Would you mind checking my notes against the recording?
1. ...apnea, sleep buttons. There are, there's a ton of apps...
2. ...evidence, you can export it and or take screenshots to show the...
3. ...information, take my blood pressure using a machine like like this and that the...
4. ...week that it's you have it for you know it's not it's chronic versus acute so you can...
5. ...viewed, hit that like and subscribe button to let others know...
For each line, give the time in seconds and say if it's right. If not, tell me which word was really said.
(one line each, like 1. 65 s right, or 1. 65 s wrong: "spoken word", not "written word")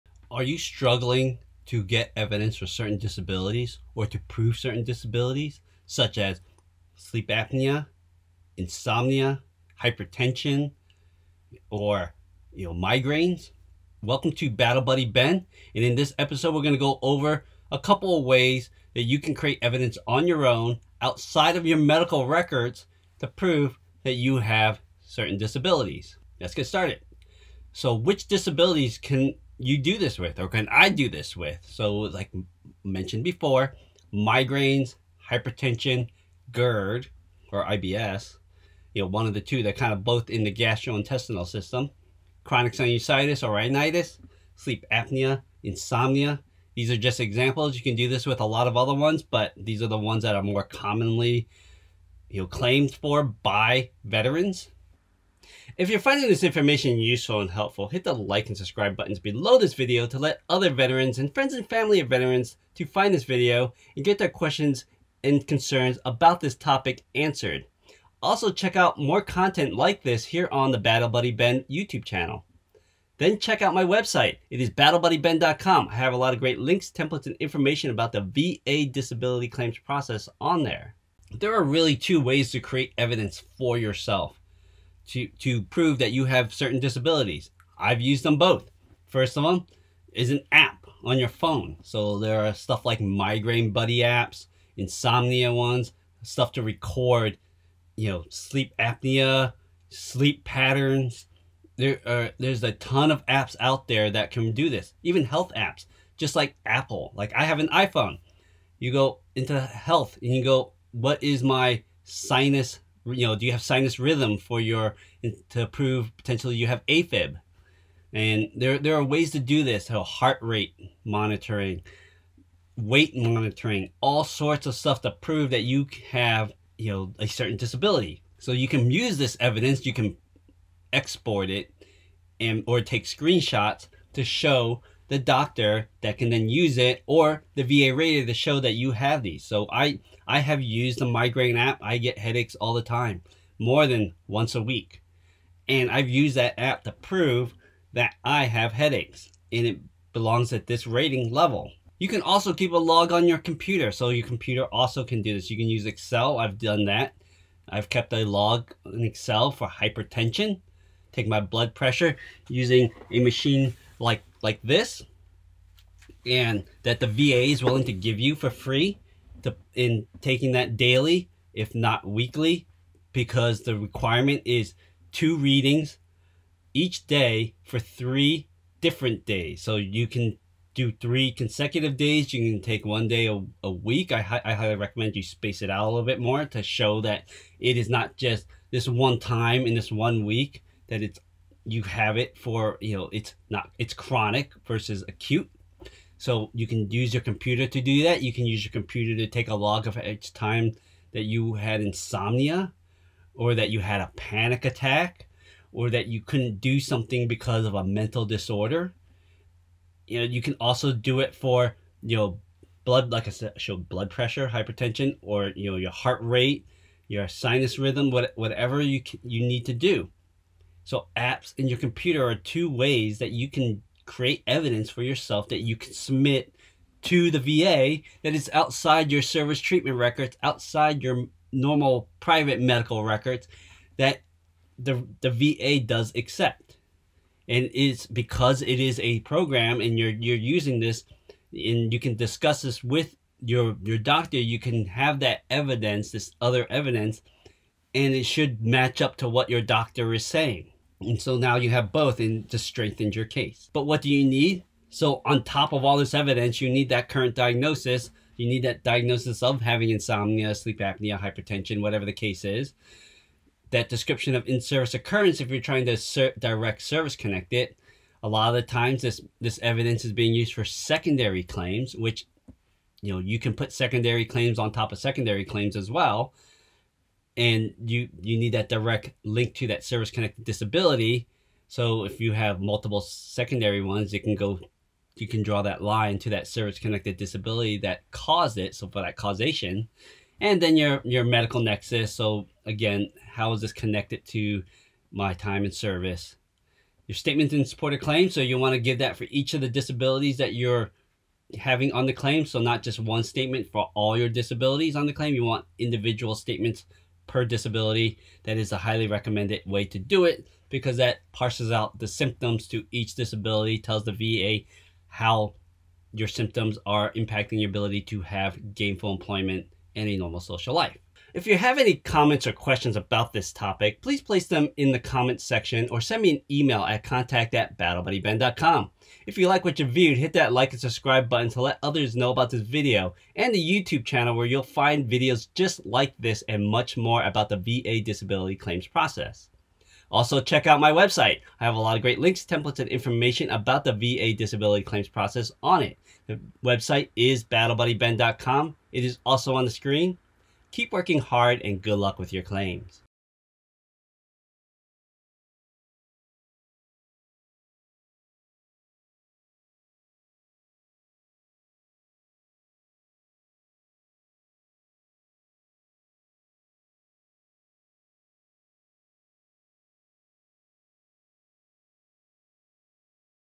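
1. 98 s wrong: "patterns", not "buttons"
2. 129 s right
3. 159 s wrong: "hypertension", not "information"
4. 190 s right
5. 329 s right.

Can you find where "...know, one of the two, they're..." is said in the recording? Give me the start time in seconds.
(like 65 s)
39 s.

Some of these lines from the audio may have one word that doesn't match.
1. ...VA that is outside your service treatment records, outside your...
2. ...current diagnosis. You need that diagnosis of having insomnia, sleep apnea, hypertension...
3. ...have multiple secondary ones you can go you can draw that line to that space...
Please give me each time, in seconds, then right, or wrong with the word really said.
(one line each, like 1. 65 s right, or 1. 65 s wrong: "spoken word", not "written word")
1. 227 s right
2. 257 s right
3. 282 s wrong: "service", not "space".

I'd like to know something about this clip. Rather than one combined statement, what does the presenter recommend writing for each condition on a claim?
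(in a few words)
Individual statements.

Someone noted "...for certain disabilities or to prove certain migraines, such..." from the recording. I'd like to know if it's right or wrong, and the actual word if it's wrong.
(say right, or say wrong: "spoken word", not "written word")
wrong: "disabilities", not "migraines".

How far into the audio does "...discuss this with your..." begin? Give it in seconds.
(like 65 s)
242 s.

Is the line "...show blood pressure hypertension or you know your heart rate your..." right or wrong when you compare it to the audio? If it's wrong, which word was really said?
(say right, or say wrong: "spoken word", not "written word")
right.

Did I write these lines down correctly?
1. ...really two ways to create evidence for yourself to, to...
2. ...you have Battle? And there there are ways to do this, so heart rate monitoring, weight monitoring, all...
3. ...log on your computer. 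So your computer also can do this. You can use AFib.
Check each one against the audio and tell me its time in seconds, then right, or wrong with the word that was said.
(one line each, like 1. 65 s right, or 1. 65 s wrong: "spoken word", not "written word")
1. 81 s right
2. 116 s wrong: "AFib", not "Battle"
3. 152 s wrong: "Excel", not "AFib".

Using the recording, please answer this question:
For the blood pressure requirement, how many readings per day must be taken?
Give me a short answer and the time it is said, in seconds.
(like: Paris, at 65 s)
2, at 175 s.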